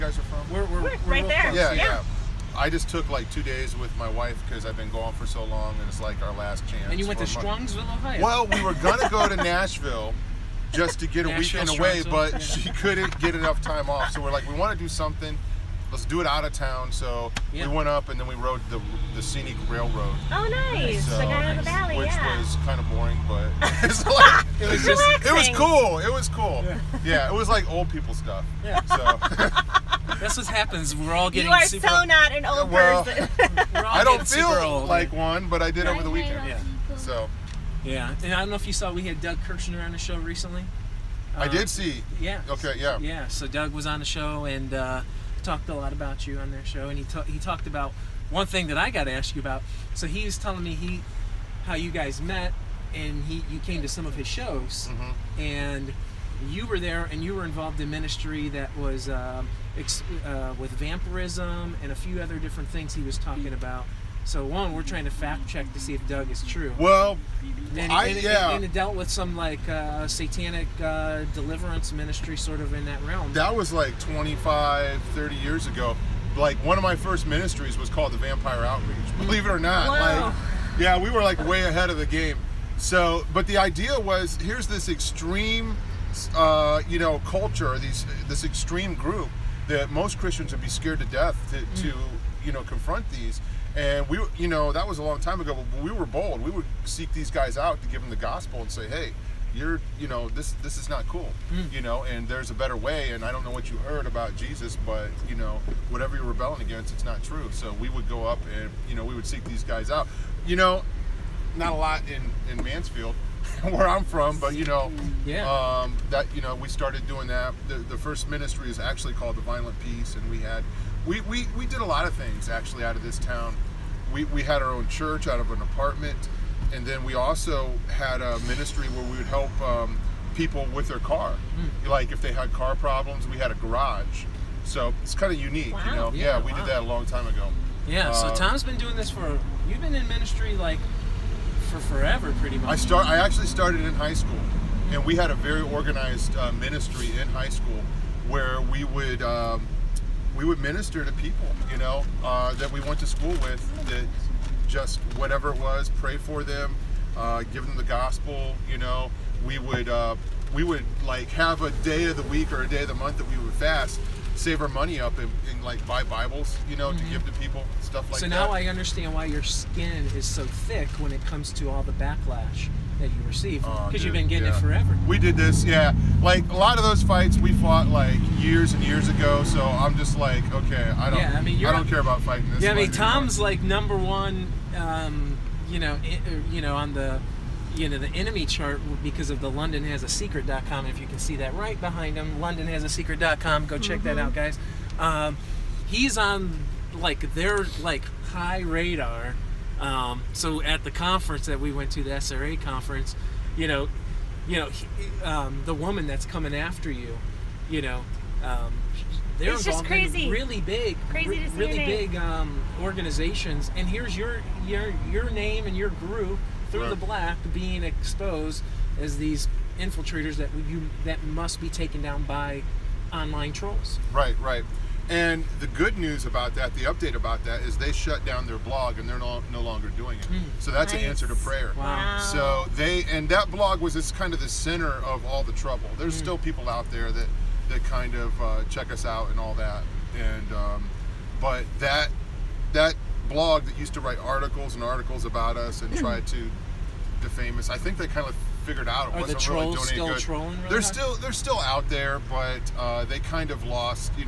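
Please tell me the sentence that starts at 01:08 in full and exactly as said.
and, and dealt with some like uh, satanic uh, deliverance ministry, sort of in that realm.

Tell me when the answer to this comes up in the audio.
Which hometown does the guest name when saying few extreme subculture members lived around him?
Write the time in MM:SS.
01:52.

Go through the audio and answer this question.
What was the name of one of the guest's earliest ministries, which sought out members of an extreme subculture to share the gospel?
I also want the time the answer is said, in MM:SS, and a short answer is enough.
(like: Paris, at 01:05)
Vampire Outreach, at 01:18.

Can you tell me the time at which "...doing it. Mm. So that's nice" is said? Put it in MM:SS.
03:49.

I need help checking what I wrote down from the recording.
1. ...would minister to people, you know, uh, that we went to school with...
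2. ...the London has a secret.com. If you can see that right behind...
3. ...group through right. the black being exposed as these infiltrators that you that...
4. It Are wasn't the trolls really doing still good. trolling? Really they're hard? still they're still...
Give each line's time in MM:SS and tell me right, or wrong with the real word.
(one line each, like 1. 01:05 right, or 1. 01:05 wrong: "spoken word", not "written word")
1. 02:30 right
2. 03:09 right
3. 03:35 right
4. 04:09 right.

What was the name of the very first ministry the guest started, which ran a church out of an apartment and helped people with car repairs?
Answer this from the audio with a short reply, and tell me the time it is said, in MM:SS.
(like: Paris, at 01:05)
Violent Peace, at 01:59.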